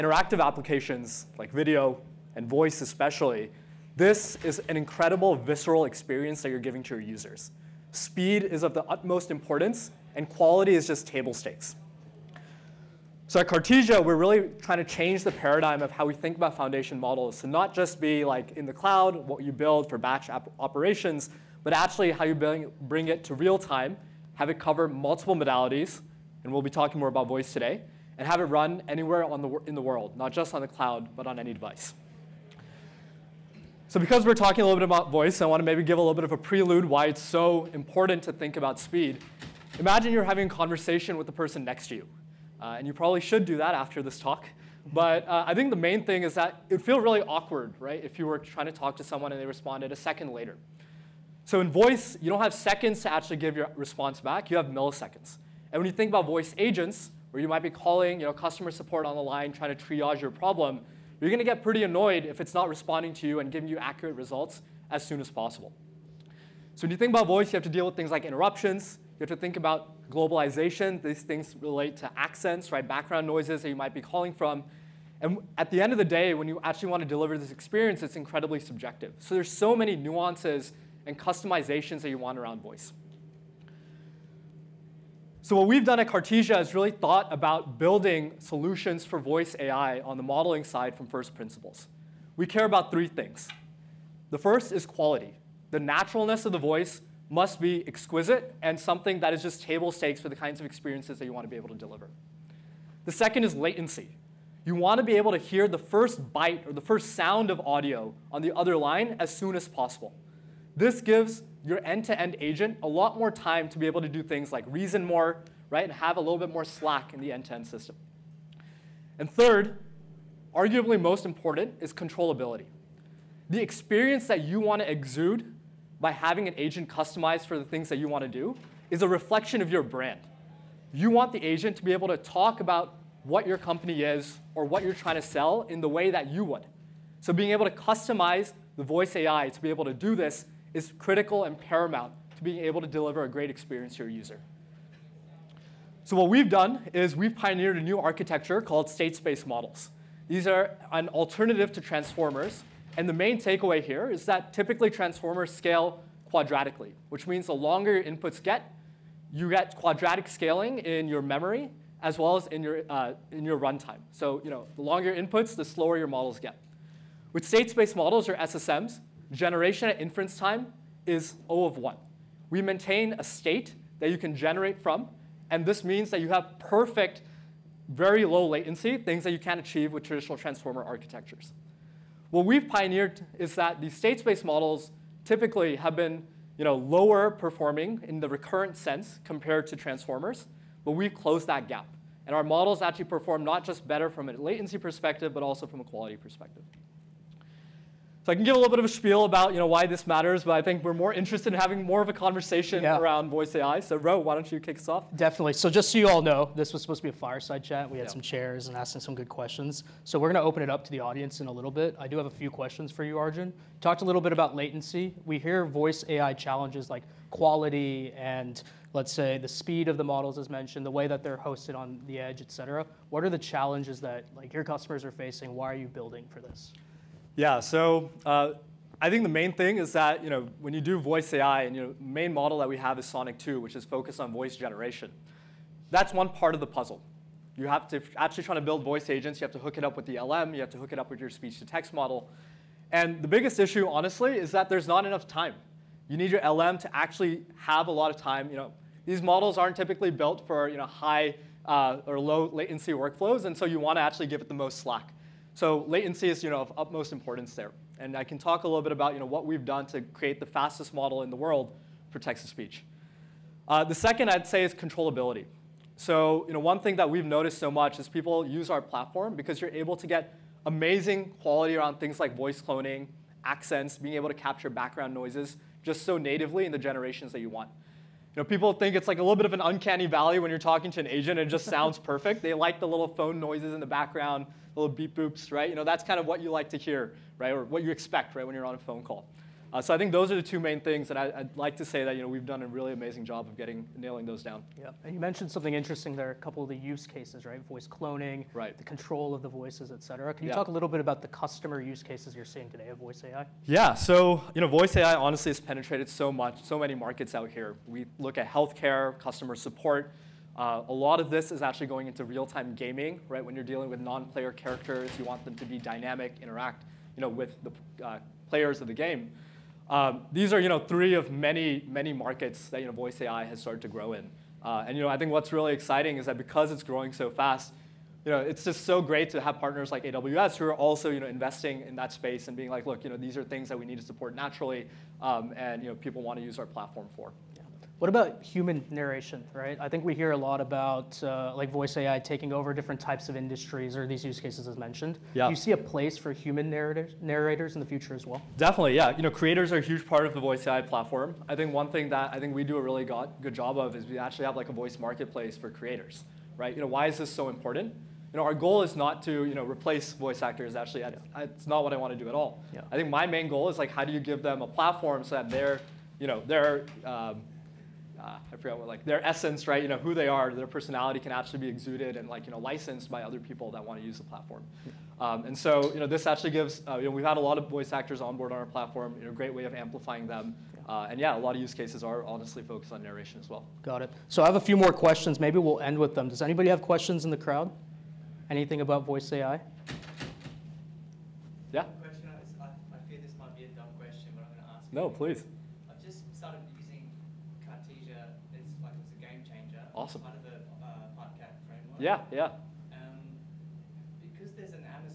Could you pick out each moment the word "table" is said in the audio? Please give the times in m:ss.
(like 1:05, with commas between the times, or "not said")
0:11, 1:39.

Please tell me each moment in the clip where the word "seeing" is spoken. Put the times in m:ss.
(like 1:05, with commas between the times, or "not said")
5:02.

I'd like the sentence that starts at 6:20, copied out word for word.
Uh, and yeah, a lot of use cases are honestly focused on narration as well.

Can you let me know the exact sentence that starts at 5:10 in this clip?
Uh, a lot of this is actually going into real-time gaming, right?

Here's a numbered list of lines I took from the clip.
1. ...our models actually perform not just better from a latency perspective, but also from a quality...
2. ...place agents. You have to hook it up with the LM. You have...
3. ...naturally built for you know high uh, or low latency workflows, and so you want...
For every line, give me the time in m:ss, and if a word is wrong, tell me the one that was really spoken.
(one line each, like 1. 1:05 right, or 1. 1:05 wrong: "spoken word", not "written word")
1. 3:12 right
2. 3:58 wrong: "voice", not "place"
3. 4:09 wrong: "typically", not "naturally".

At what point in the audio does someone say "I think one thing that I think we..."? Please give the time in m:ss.
5:51.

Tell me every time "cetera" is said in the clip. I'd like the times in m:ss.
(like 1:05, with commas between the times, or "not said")
3:42, 5:00.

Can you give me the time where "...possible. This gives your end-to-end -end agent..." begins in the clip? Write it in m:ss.
1:49.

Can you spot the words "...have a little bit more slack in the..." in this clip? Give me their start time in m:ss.
1:55.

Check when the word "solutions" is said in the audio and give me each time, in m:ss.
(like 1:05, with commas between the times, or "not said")
1:28.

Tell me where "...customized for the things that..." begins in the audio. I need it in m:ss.
2:06.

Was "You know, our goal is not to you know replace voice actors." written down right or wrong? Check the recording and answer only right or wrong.
right.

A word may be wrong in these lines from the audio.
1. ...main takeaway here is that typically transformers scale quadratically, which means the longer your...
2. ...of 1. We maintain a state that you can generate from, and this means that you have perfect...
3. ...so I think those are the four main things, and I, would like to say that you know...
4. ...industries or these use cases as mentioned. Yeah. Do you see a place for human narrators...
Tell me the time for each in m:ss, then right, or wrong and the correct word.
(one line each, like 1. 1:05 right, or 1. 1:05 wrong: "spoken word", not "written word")
1. 2:33 right
2. 2:51 right
3. 4:49 wrong: "two", not "four"
4. 5:43 right.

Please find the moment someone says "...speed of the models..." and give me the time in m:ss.
3:39.